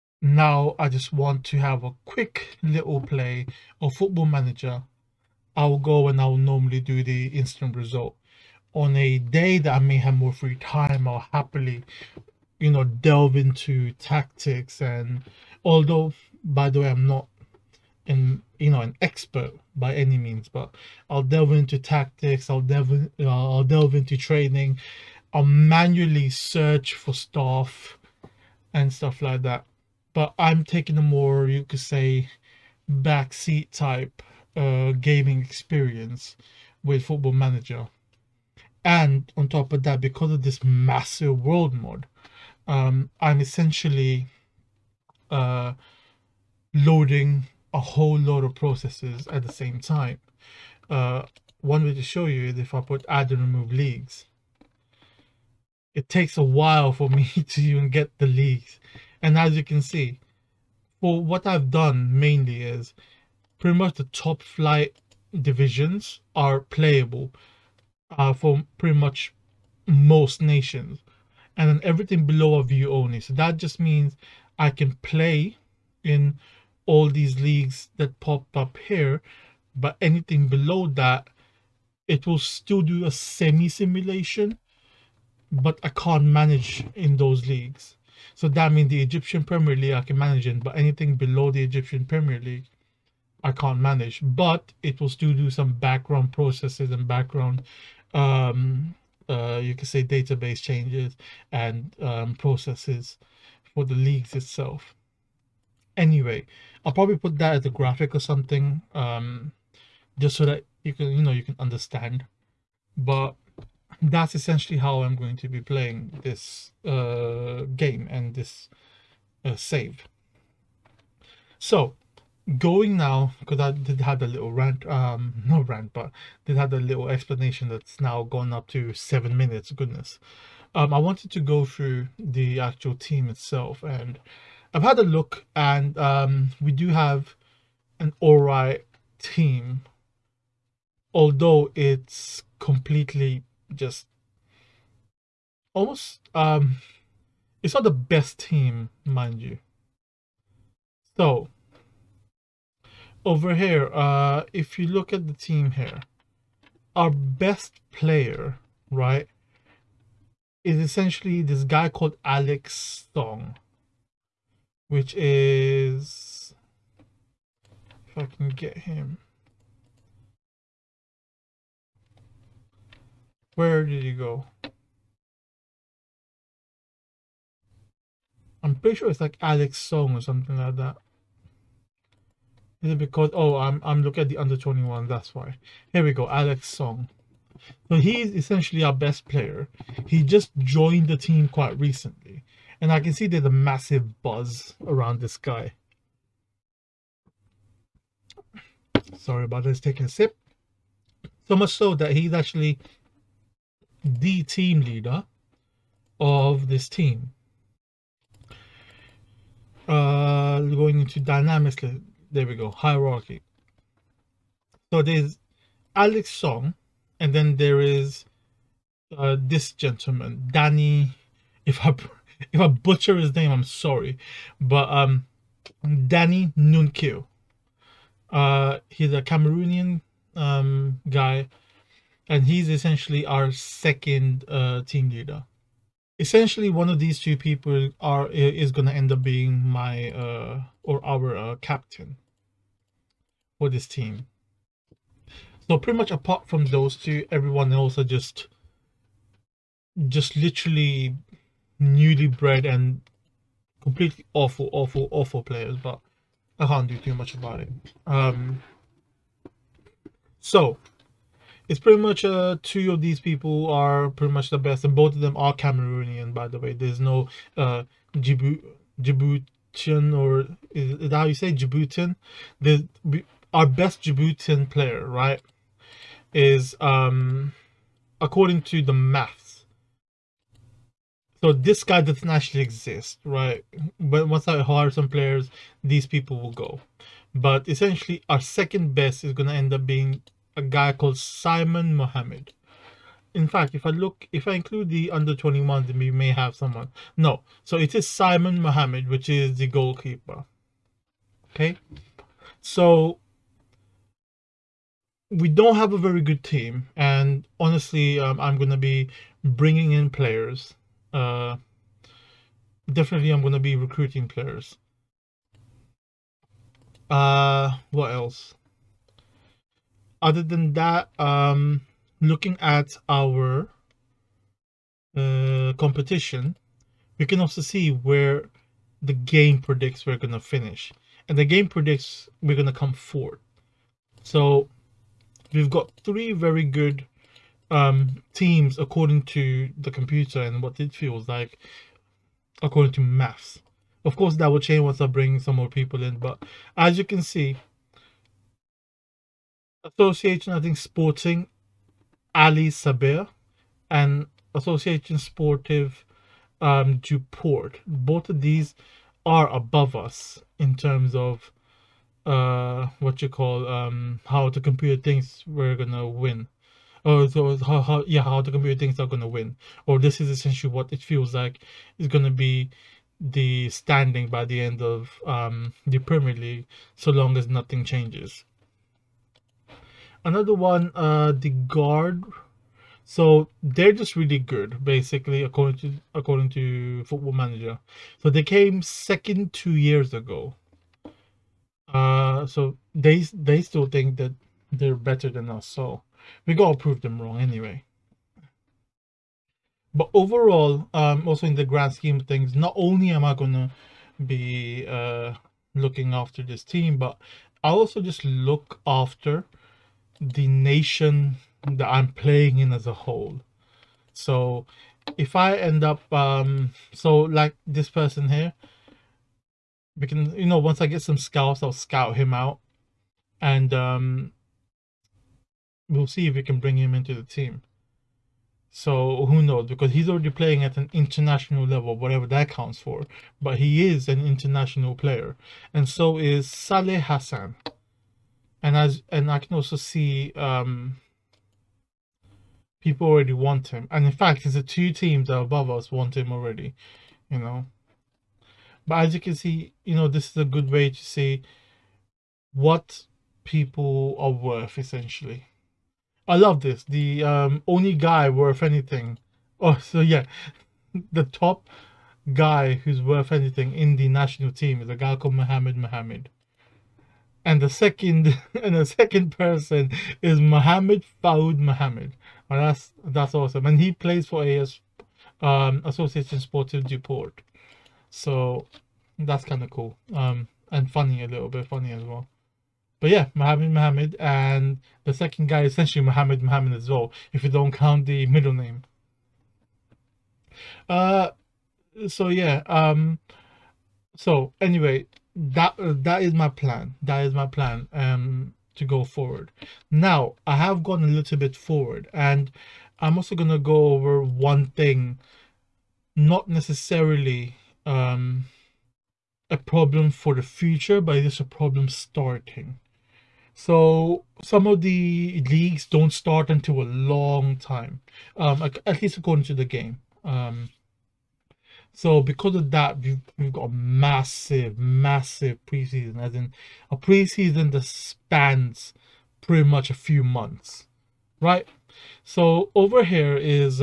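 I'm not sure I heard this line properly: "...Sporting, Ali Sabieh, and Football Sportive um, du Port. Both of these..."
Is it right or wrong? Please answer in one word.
wrong.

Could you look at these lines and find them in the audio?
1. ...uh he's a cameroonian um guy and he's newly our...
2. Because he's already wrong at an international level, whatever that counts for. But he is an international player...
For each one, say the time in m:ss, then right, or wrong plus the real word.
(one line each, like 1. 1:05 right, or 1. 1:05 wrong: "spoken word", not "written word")
1. 3:48 wrong: "essentially", not "newly"
2. 7:09 wrong: "playing", not "wrong".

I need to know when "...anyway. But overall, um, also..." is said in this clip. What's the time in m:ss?
6:37.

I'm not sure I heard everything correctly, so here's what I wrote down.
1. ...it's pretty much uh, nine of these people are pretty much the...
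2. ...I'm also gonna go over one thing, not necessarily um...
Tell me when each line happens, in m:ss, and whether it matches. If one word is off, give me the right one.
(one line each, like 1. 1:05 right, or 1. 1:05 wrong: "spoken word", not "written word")
1. 4:21 wrong: "two", not "nine"
2. 8:22 right.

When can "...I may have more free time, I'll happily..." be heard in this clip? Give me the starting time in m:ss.
0:09.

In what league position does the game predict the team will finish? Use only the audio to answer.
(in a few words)
4th.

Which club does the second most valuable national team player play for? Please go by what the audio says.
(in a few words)
Association Sportive du Port.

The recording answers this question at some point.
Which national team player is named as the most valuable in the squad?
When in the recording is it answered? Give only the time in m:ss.
7:45.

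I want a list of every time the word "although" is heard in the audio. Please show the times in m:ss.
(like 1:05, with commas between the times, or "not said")
0:15, 2:21.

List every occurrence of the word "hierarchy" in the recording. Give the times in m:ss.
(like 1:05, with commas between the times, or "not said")
3:32.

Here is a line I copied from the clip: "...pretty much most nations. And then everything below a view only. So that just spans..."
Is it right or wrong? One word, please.
wrong.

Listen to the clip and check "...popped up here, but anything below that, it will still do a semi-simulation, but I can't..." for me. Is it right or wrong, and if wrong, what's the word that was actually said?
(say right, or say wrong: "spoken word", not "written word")
right.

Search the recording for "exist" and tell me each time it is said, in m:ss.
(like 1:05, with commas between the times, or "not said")
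4:42.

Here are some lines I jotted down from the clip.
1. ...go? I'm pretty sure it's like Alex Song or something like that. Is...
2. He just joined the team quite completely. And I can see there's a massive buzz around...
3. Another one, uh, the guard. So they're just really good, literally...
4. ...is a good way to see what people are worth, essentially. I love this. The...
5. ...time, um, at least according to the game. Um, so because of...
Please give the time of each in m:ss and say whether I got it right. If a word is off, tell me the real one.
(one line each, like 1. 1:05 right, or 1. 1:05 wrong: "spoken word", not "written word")
1. 2:54 right
2. 3:10 wrong: "recently", not "completely"
3. 6:20 wrong: "basically", not "literally"
4. 7:30 right
5. 8:37 right.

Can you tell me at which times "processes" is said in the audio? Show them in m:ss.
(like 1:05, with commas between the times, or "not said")
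0:48, 1:36, 1:42.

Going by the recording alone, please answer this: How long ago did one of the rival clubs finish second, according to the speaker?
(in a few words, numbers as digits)
2 years ago.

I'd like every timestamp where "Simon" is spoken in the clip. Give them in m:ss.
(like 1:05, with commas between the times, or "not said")
4:51, 4:58.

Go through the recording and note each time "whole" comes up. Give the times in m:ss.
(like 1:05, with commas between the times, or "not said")
0:47, 6:52.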